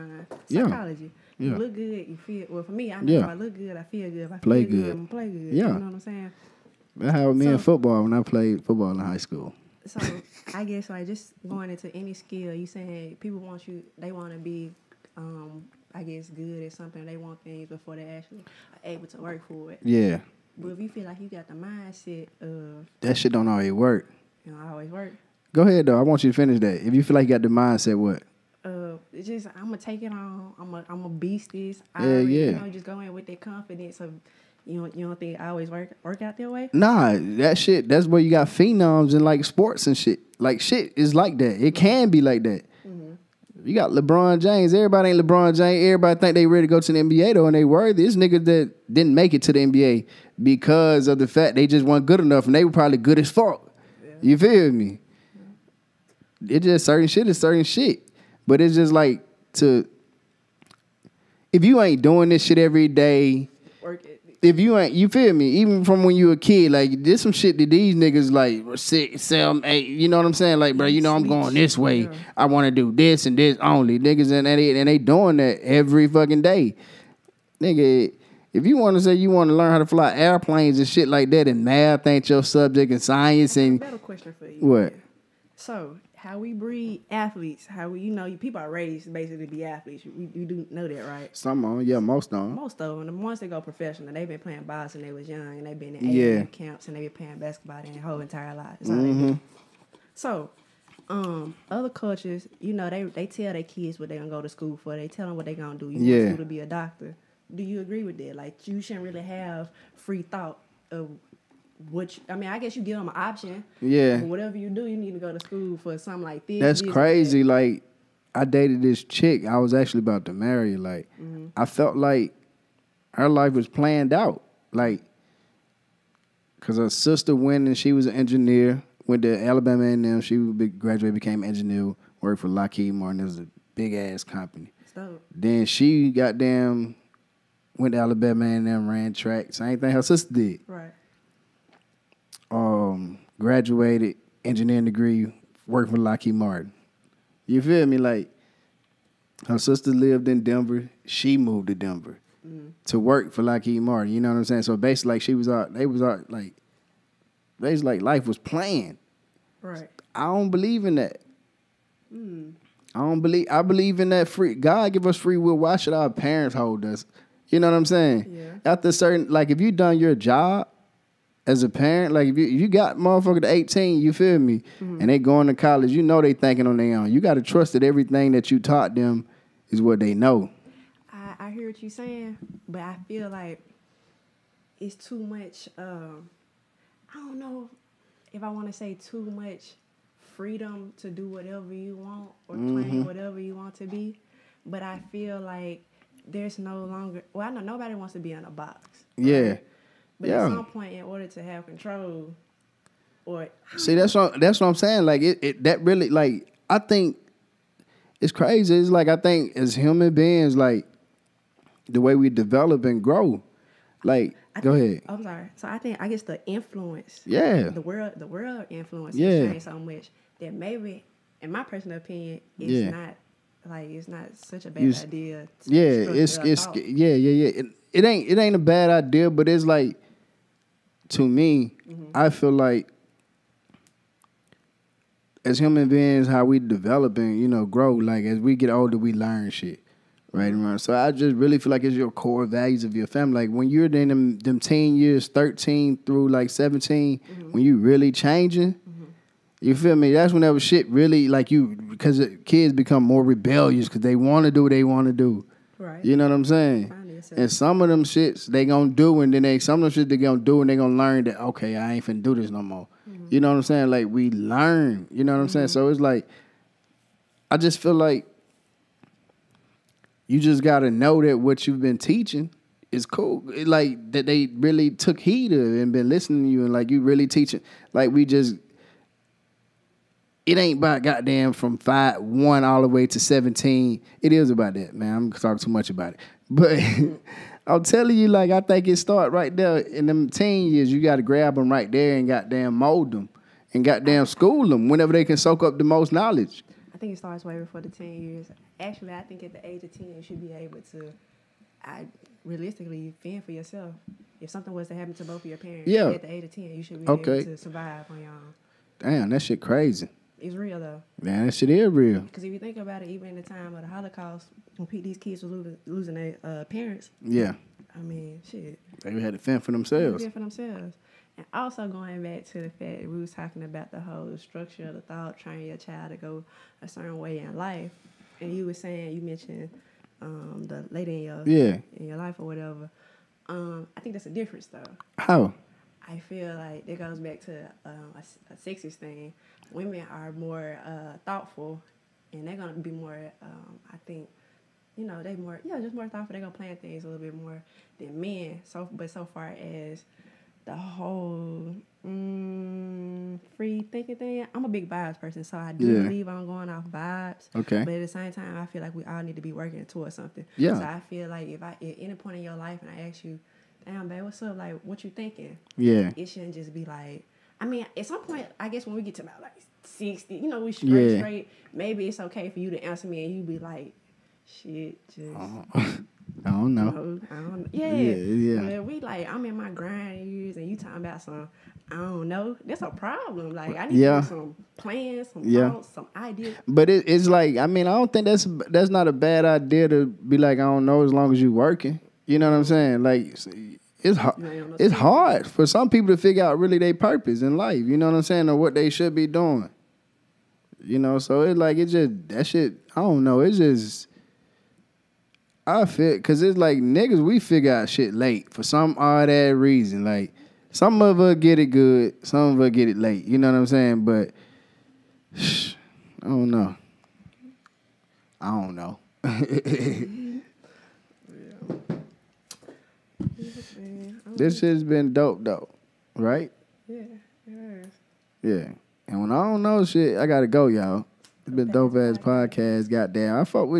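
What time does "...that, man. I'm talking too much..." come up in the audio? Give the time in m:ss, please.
4:44.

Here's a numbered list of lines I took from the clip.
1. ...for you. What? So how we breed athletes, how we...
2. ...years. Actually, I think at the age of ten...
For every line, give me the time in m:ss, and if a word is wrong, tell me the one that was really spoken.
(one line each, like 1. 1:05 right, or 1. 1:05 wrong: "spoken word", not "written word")
1. 1:24 right
2. 4:58 right.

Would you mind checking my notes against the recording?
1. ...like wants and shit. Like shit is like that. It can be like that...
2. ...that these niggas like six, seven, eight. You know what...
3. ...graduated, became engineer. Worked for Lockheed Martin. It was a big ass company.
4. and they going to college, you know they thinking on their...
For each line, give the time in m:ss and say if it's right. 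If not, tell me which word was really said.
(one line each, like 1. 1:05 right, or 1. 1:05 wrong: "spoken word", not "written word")
1. 0:39 wrong: "sports", not "wants"
2. 1:07 right
3. 2:10 right
4. 2:54 right.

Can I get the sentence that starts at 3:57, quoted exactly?
Like as we get older, we learn shit, right So I just really feel like it's your core values of your family.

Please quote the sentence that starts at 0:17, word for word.
They want things before they actually able to work for it.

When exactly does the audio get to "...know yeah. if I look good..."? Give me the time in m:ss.
0:02.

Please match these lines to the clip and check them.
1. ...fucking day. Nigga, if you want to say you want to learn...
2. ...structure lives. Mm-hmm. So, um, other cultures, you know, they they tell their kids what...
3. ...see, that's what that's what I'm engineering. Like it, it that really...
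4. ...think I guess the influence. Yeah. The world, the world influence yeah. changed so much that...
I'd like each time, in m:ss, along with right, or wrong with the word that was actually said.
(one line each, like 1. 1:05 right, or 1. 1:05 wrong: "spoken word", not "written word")
1. 1:16 right
2. 1:38 wrong: "entire", not "structure"
3. 3:23 wrong: "saying", not "engineering"
4. 3:35 right.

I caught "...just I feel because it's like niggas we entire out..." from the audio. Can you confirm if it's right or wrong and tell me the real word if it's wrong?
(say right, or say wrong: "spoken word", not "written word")
wrong: "figure", not "entire".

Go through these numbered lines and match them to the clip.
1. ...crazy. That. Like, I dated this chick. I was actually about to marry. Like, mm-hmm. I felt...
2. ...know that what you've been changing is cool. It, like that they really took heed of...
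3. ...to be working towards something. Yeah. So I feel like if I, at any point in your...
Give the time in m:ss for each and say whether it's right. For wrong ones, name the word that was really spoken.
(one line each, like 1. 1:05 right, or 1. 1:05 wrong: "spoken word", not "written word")
1. 1:56 right
2. 4:30 wrong: "teaching", not "changing"
3. 5:59 right.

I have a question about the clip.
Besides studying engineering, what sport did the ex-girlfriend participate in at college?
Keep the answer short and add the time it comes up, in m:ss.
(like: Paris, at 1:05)
Track, at 2:18.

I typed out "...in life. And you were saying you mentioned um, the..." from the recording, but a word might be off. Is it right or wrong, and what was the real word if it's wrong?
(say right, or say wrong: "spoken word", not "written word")
right.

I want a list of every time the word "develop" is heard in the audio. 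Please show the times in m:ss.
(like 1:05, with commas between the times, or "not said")
3:32, 3:56.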